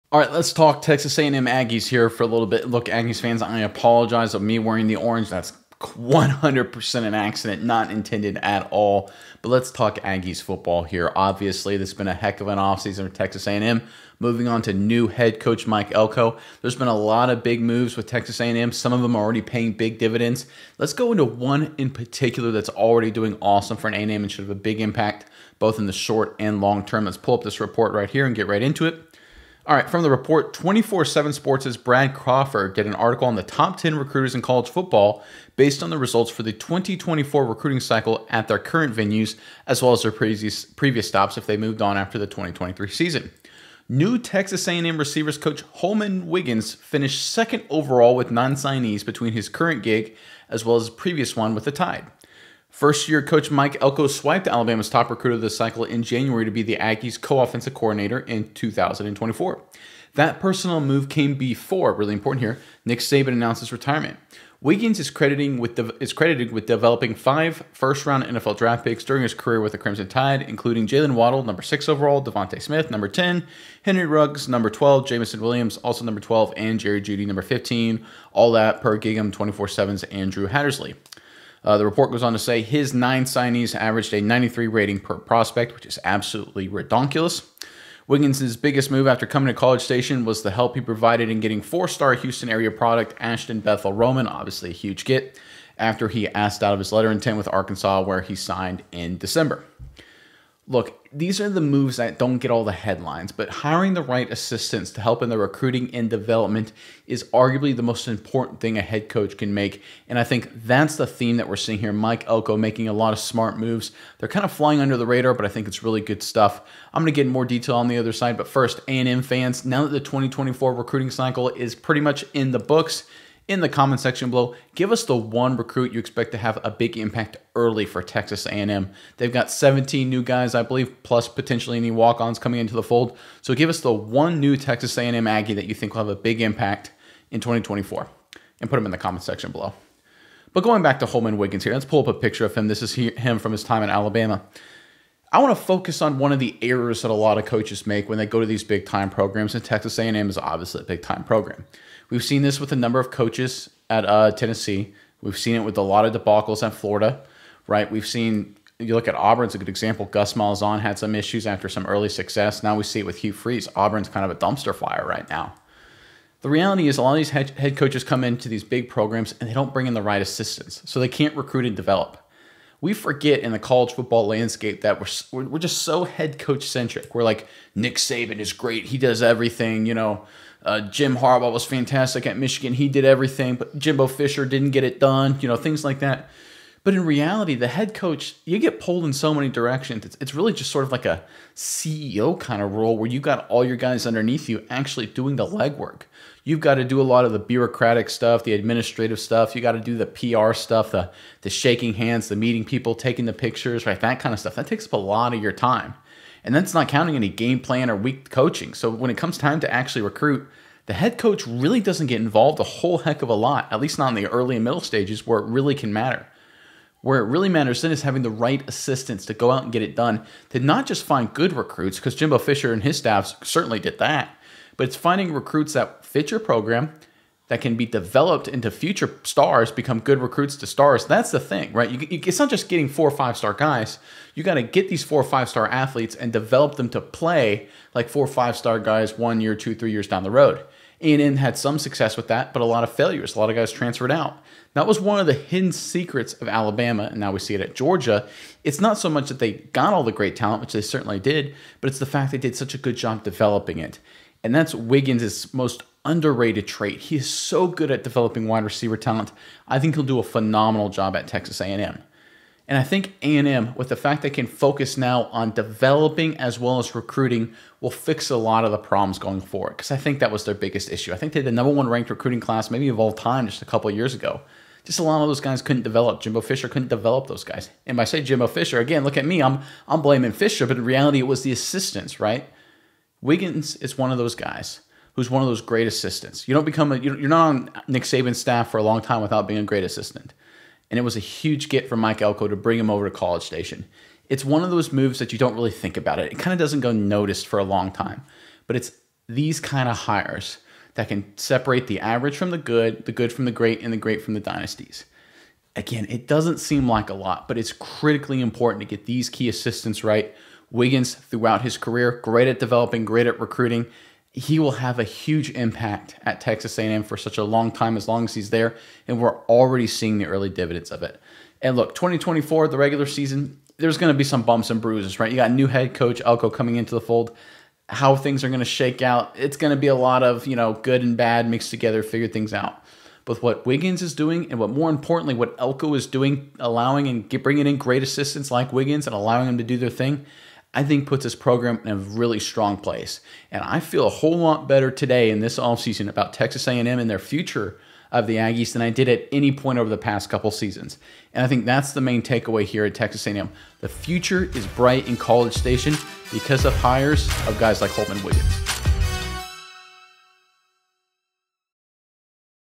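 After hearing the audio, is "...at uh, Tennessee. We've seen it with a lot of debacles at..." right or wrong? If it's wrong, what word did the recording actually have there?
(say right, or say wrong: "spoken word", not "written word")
right.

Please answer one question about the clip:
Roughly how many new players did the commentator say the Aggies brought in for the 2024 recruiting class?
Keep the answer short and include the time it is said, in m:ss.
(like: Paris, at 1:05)
17, at 2:09.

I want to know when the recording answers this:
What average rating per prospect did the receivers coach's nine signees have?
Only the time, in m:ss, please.
1:24.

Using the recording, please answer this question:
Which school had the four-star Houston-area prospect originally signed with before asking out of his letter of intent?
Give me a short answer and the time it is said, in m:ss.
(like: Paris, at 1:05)
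Arkansas, at 1:37.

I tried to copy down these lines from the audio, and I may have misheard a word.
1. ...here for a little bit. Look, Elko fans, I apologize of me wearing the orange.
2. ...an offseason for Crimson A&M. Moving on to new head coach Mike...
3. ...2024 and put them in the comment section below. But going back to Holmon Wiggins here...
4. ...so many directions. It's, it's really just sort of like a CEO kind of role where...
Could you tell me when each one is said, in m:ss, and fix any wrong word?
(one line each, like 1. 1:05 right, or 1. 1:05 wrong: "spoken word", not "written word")
1. 0:01 wrong: "Aggies", not "Elko"
2. 0:12 wrong: "Texas", not "Crimson"
3. 2:17 right
4. 3:09 right.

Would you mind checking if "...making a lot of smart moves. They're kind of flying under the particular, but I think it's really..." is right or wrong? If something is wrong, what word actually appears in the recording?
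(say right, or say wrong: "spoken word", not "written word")
wrong: "radar", not "particular".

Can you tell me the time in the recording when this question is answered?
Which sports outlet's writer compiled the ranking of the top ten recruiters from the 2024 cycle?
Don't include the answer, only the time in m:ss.
0:30.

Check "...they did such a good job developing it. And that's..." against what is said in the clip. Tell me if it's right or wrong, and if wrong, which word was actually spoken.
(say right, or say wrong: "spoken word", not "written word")
right.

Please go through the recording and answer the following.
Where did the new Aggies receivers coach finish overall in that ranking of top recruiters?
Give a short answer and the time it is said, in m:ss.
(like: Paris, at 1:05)
Second, at 0:47.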